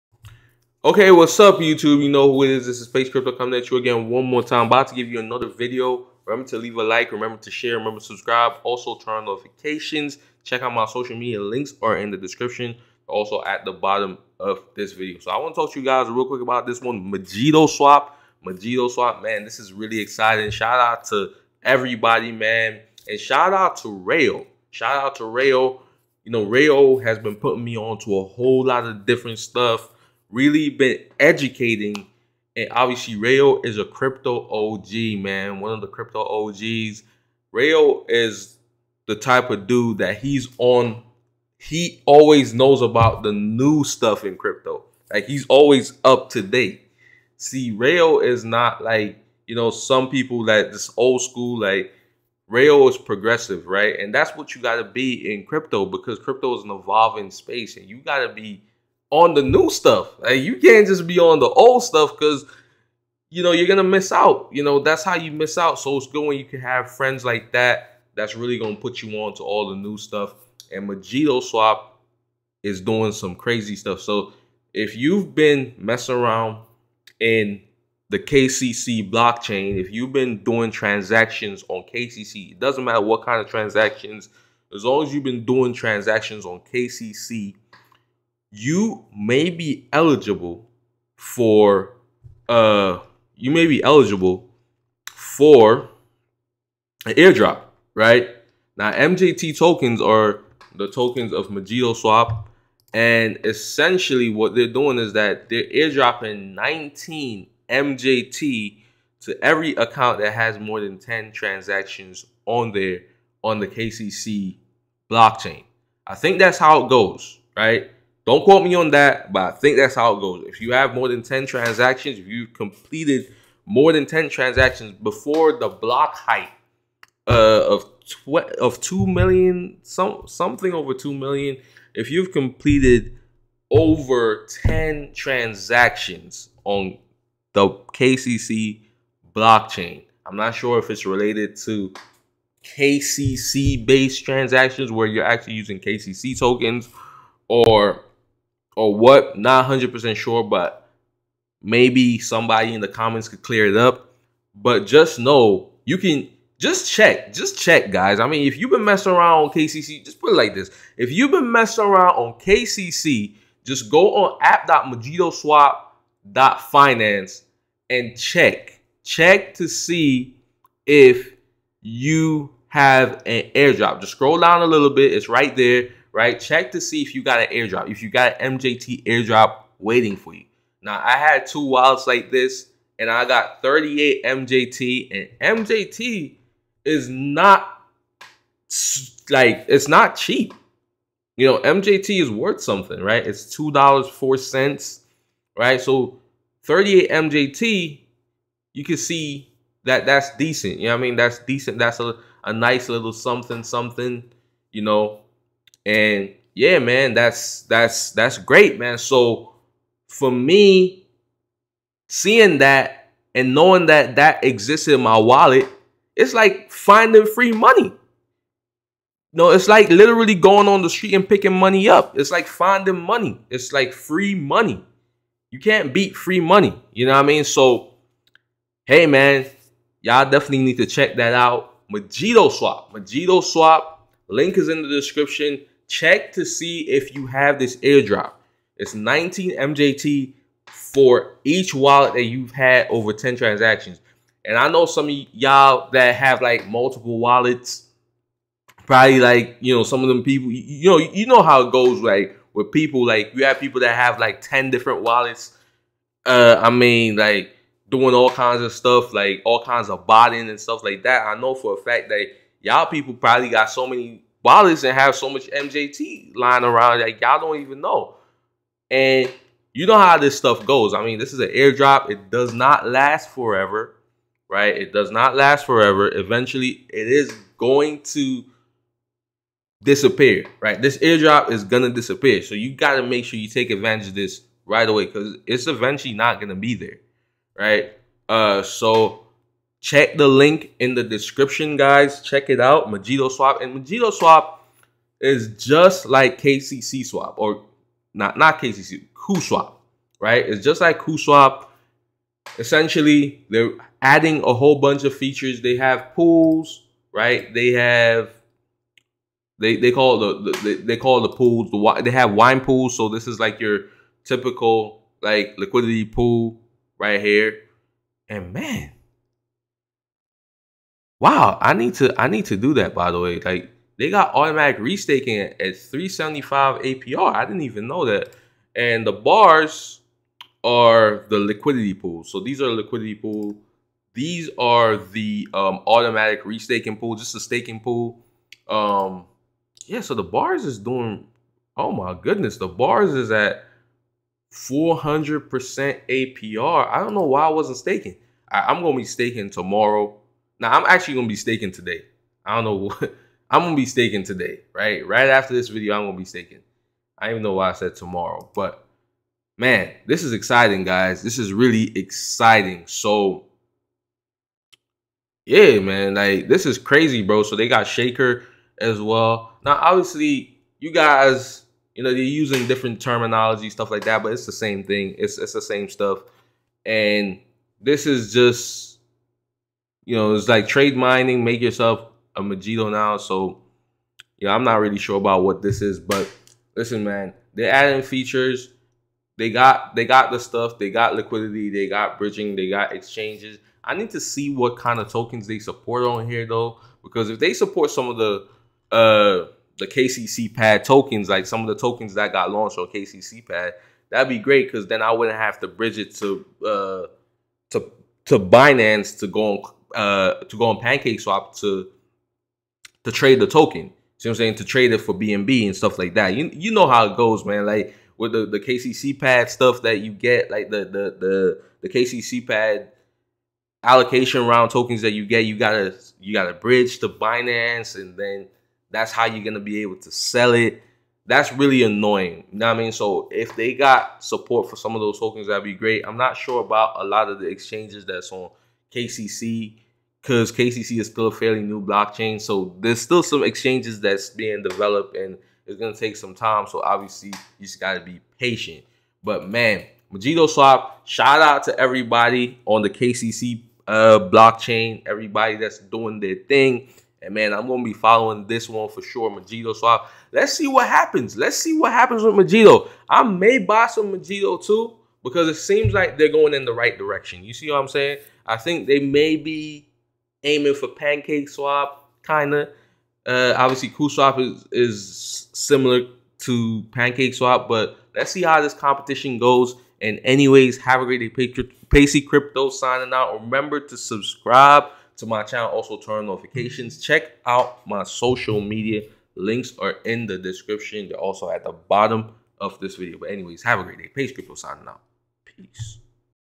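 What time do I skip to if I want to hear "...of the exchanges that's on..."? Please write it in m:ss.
7:17.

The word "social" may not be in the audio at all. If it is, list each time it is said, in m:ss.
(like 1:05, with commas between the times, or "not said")
0:10, 8:08.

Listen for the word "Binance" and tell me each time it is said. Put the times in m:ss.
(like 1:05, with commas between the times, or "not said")
6:48, 7:07.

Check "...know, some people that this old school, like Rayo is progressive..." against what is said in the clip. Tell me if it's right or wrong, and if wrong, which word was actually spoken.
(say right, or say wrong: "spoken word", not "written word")
right.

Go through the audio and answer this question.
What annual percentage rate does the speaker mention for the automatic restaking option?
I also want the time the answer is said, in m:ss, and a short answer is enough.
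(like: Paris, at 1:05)
375, at 5:25.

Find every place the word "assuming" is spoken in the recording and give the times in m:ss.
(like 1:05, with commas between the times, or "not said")
not said.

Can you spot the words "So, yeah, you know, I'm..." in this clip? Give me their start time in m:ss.
6:23.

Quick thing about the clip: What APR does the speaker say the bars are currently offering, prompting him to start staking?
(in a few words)
400%.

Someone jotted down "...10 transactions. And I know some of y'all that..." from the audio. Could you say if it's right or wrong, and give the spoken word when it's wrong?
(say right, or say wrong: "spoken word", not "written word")
right.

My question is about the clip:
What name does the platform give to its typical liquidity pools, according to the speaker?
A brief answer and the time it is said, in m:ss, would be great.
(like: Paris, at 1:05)
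wine pools, at 5:12.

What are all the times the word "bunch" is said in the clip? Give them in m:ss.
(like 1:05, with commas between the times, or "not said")
5:04.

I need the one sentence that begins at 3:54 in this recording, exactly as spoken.
Link is in the description check to see if you have this airdrop.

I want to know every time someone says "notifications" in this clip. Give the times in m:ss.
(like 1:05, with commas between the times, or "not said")
0:09, 8:06.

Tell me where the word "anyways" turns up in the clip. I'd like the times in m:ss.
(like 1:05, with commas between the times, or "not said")
8:00, 8:13.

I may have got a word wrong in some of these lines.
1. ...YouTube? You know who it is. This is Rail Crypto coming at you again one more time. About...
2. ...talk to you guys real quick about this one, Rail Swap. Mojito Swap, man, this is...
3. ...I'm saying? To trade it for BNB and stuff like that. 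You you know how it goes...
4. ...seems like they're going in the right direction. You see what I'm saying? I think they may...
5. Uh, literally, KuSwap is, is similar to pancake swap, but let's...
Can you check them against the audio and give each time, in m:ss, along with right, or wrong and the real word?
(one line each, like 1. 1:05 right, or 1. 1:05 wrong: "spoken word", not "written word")
1. 0:01 wrong: "Pacey", not "Rail"
2. 0:15 wrong: "Mojito", not "Rail"
3. 6:54 right
4. 7:45 right
5. 7:53 wrong: "obviously", not "literally".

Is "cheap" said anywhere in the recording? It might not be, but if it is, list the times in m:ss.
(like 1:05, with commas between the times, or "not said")
3:10.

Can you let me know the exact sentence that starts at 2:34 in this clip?
But just know you can just check, just check, guys.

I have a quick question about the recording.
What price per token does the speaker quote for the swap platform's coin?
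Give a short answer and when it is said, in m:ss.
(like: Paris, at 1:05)
$2.04, at 3:13.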